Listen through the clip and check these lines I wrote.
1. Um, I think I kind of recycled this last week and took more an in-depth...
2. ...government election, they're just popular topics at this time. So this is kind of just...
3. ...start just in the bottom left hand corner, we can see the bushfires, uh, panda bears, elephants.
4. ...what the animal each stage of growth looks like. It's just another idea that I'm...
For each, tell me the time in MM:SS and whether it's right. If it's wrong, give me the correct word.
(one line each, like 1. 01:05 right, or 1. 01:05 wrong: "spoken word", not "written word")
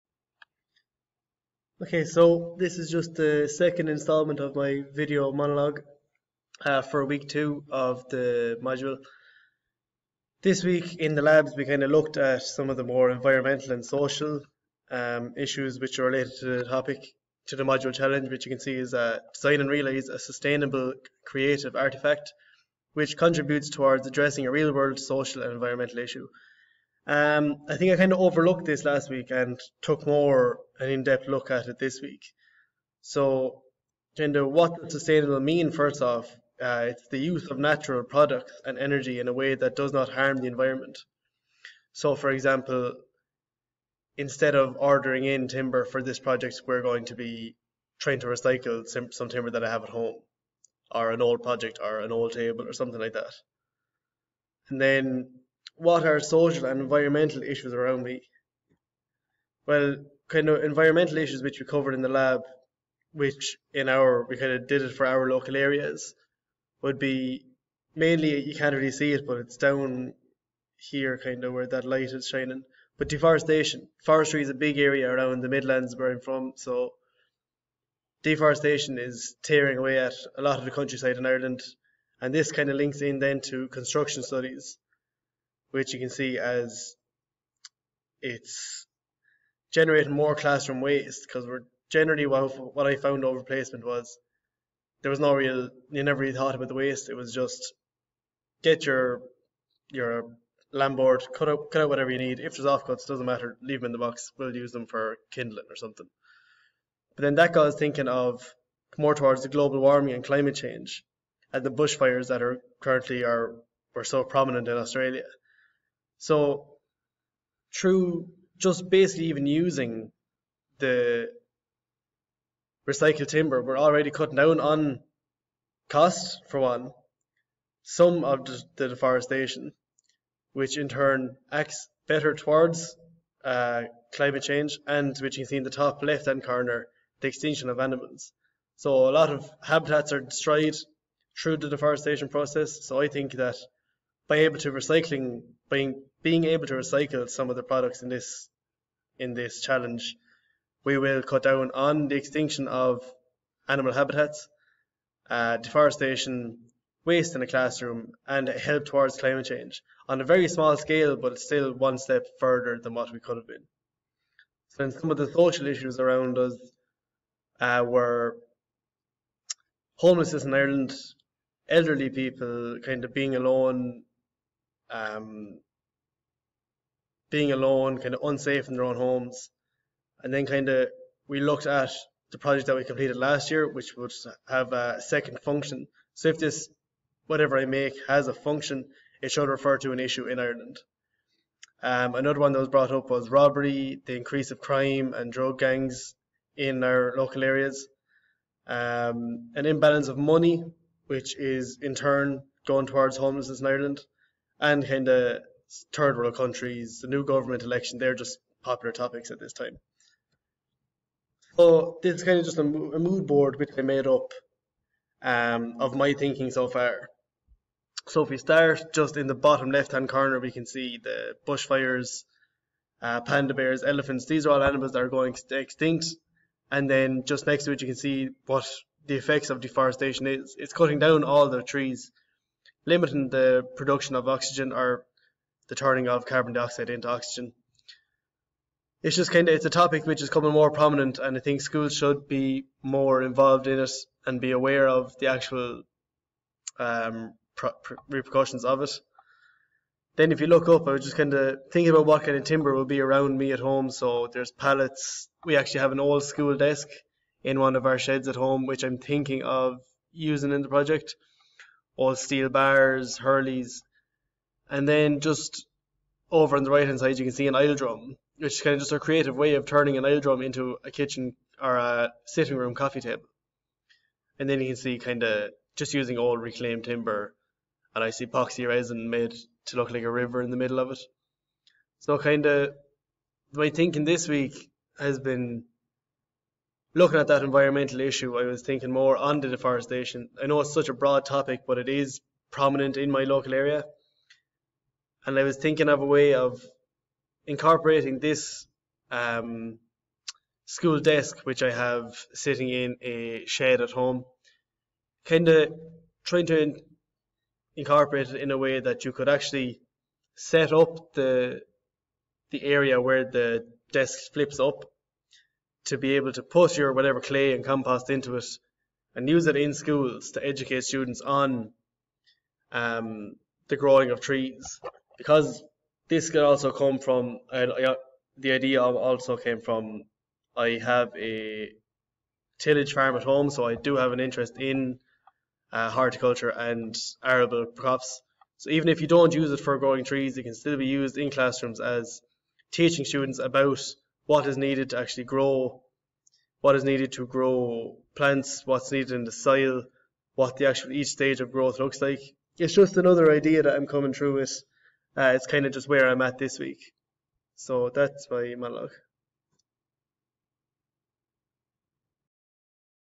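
1. 00:27 wrong: "overlooked", not "recycled"
2. 03:27 right
3. 03:38 right
4. 05:50 wrong: "actual", not "animal".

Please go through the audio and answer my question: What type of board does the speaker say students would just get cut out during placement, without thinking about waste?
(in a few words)
lamb board.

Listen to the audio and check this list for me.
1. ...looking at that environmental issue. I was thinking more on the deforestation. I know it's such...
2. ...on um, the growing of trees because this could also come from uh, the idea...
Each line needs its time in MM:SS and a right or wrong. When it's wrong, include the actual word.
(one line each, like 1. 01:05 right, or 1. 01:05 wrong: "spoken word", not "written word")
1. 04:46 right
2. 05:21 right.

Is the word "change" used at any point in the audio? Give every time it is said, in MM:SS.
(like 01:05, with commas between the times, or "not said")
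01:50, 02:14, 02:39.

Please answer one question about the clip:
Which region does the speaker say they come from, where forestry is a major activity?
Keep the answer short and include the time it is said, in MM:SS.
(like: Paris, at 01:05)
the Midlands, at 01:15.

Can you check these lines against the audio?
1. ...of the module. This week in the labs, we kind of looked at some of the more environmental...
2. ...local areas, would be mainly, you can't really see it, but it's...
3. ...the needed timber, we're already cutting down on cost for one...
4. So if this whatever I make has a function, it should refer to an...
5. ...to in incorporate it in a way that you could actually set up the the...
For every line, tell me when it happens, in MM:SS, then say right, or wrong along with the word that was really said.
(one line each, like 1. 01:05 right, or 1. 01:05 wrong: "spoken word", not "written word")
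1. 00:07 right
2. 01:05 right
3. 02:00 wrong: "recycled", not "needed"
4. 03:06 right
5. 05:06 right.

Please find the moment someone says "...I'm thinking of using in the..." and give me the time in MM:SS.
04:18.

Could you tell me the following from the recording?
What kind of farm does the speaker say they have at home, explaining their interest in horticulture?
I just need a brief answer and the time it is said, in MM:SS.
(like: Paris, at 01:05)
tillage farm, at 05:32.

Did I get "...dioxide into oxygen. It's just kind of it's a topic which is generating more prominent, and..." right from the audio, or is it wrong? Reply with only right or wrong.
wrong.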